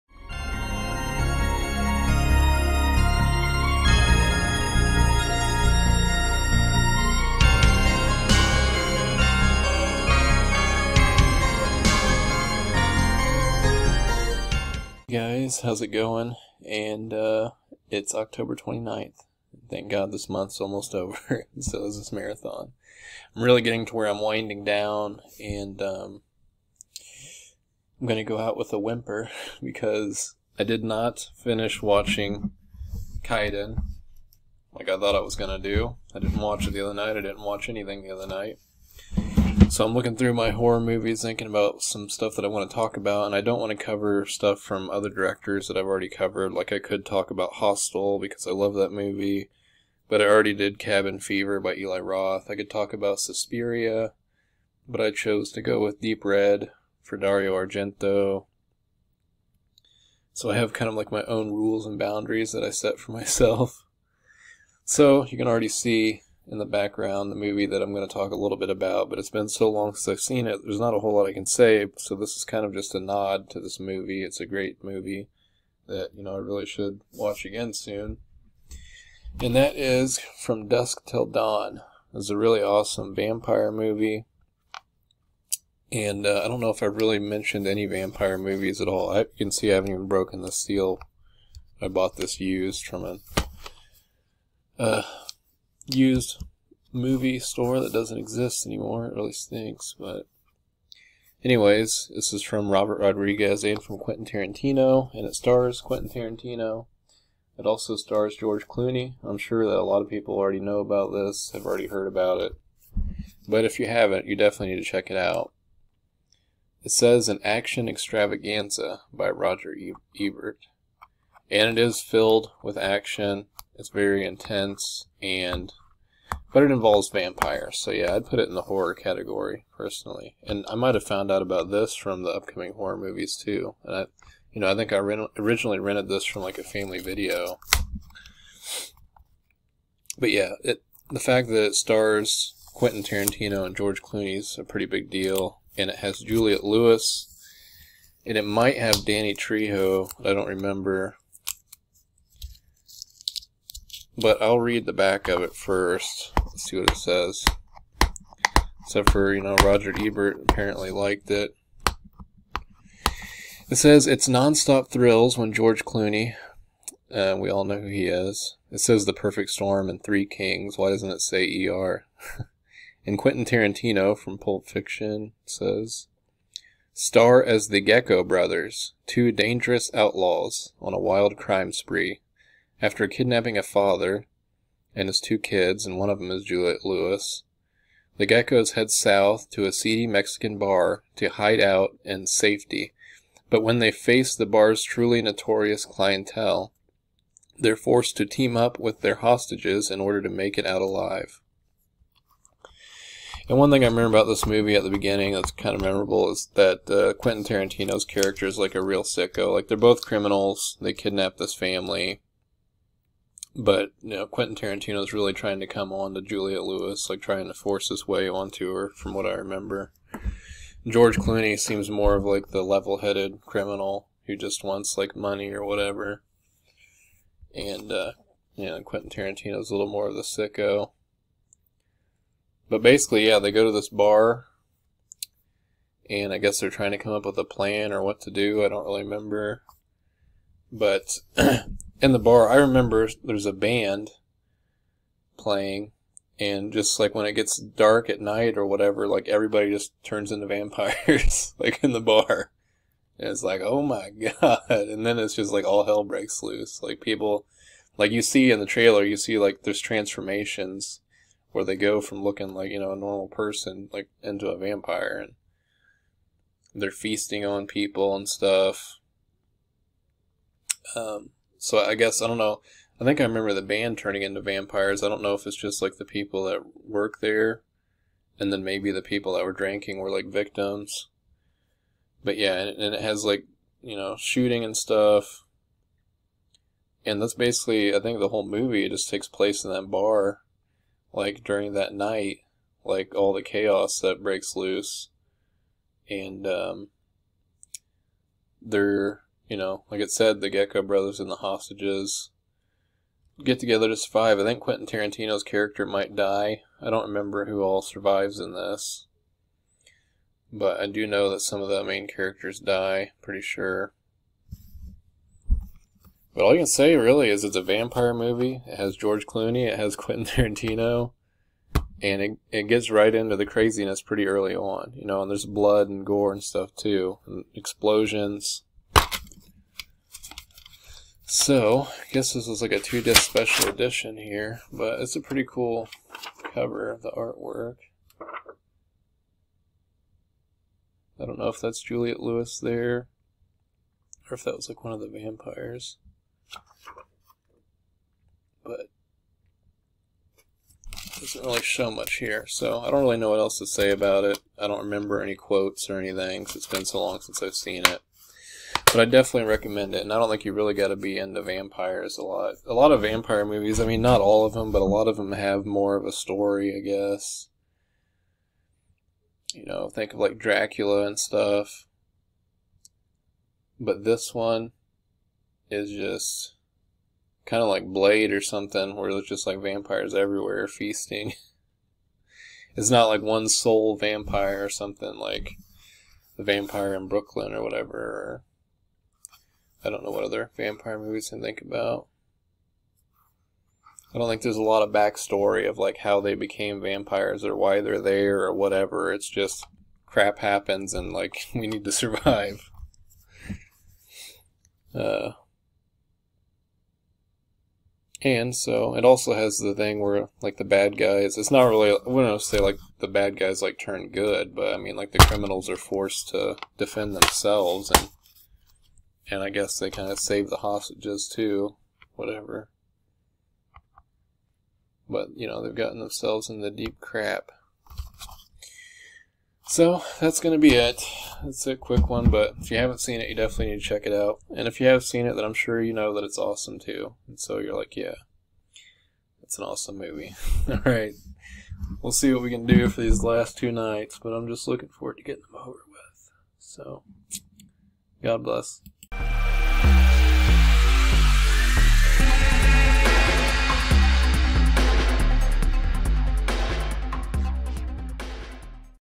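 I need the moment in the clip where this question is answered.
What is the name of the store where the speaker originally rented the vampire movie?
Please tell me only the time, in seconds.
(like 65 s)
136 s.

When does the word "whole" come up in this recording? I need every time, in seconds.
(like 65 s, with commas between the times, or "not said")
70 s, 288 s.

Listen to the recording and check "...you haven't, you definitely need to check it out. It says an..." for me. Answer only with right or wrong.
right.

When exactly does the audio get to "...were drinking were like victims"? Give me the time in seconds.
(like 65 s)
279 s.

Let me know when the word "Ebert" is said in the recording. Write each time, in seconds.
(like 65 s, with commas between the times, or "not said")
120 s, 159 s.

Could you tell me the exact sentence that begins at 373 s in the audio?
But this one is just kind of like Blade or something, where there's just like vampires everywhere feasting.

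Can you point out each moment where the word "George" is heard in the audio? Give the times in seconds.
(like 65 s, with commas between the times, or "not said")
108 s, 143 s, 165 s, 220 s, 318 s.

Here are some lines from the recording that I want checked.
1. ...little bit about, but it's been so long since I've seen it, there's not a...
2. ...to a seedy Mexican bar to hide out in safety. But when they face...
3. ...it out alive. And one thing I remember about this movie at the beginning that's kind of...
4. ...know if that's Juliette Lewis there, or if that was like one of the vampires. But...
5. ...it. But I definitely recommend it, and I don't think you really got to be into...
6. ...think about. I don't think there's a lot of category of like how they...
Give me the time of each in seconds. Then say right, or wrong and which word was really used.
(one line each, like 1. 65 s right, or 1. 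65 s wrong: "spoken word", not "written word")
1. 68 s right
2. 189 s right
3. 200 s right
4. 341 s right
5. 357 s right
6. 391 s wrong: "backstory", not "category".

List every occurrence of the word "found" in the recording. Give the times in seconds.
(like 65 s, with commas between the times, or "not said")
131 s.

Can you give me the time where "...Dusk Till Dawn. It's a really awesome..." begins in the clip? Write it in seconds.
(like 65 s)
80 s.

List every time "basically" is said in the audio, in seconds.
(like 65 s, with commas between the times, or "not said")
232 s, 287 s.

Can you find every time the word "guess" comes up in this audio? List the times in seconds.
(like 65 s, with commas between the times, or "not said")
236 s, 271 s, 332 s, 366 s, 419 s.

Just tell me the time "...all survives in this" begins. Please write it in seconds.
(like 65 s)
307 s.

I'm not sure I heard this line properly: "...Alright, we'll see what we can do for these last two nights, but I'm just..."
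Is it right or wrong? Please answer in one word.
right.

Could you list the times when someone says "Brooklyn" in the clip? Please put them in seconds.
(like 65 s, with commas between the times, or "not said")
387 s.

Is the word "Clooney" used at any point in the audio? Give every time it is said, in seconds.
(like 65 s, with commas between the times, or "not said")
108 s, 144 s, 165 s, 221 s, 319 s.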